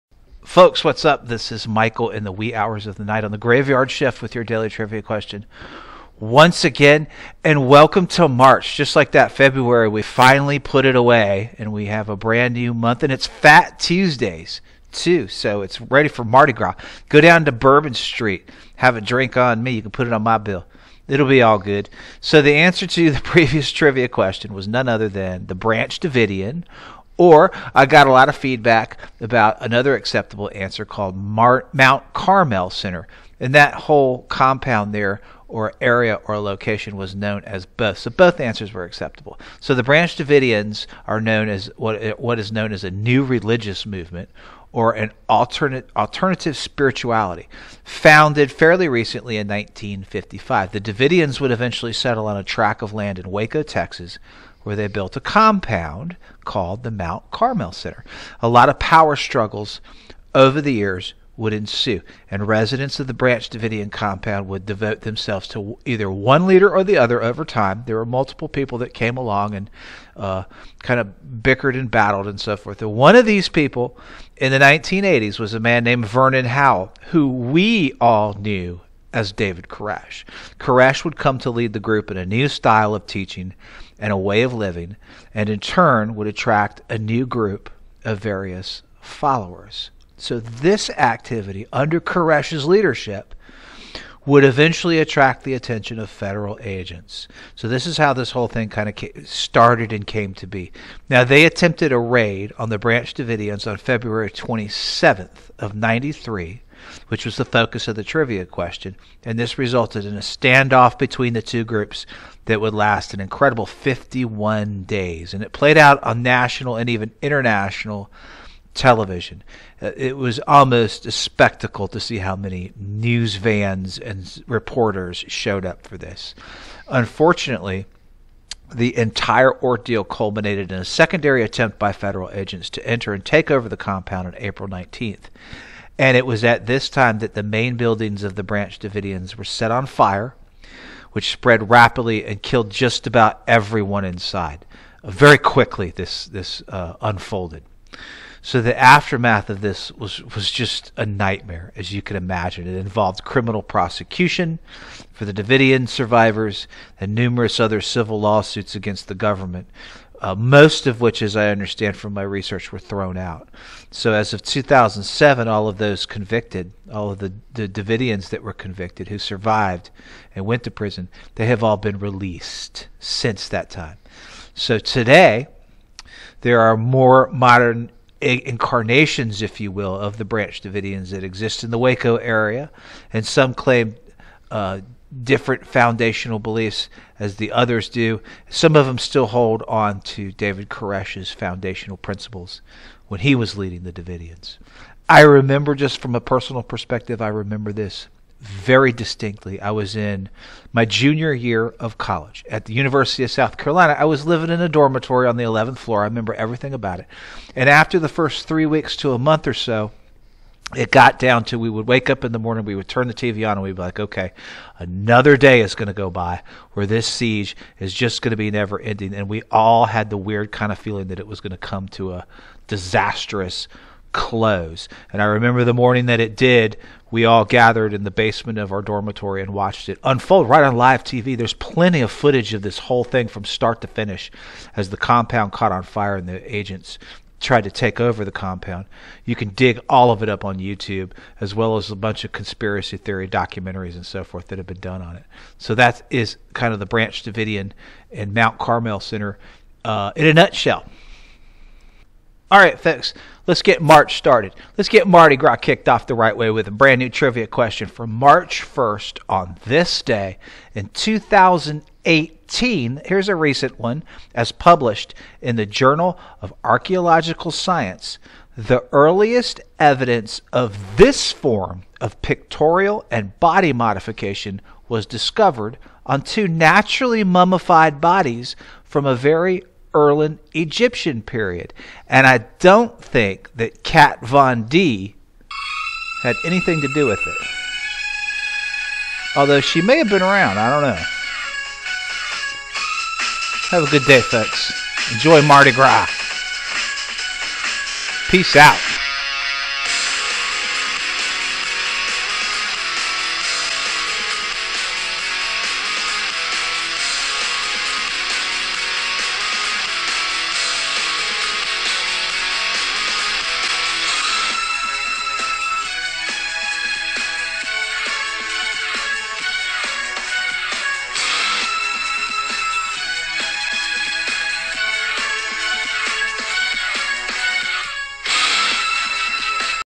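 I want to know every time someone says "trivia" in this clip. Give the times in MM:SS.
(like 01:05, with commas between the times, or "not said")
00:04, 00:23, 01:48, 04:17.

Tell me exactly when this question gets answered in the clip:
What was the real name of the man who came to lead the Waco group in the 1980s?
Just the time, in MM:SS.
01:16.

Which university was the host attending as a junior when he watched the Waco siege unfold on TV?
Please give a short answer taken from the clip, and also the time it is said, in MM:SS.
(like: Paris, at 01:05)
University of South Carolina, at 03:22.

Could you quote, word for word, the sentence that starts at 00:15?
So it's ready for Mardi Gras.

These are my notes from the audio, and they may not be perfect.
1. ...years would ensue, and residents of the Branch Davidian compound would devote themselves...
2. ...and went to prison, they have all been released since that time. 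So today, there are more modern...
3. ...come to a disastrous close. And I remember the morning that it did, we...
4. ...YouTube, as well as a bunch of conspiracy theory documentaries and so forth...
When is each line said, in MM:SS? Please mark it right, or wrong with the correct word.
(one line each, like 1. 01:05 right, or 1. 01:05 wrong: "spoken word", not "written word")
1. 01:00 right
2. 02:50 right
3. 03:41 right
4. 04:00 right.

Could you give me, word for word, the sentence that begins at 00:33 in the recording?
And that whole compound there or area or location was known as both.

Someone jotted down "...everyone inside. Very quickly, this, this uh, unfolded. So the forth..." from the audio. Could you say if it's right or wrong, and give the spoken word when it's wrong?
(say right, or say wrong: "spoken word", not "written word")
wrong: "aftermath", not "forth".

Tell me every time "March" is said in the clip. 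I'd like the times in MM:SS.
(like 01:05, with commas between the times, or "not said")
00:08, 04:13, 04:18.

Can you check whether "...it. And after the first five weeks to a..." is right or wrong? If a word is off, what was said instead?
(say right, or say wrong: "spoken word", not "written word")
wrong: "three", not "five".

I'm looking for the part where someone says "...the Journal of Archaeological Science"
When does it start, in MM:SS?
04:25.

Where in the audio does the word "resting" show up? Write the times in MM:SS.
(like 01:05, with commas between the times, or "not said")
not said.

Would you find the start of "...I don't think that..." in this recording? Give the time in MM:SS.
04:42.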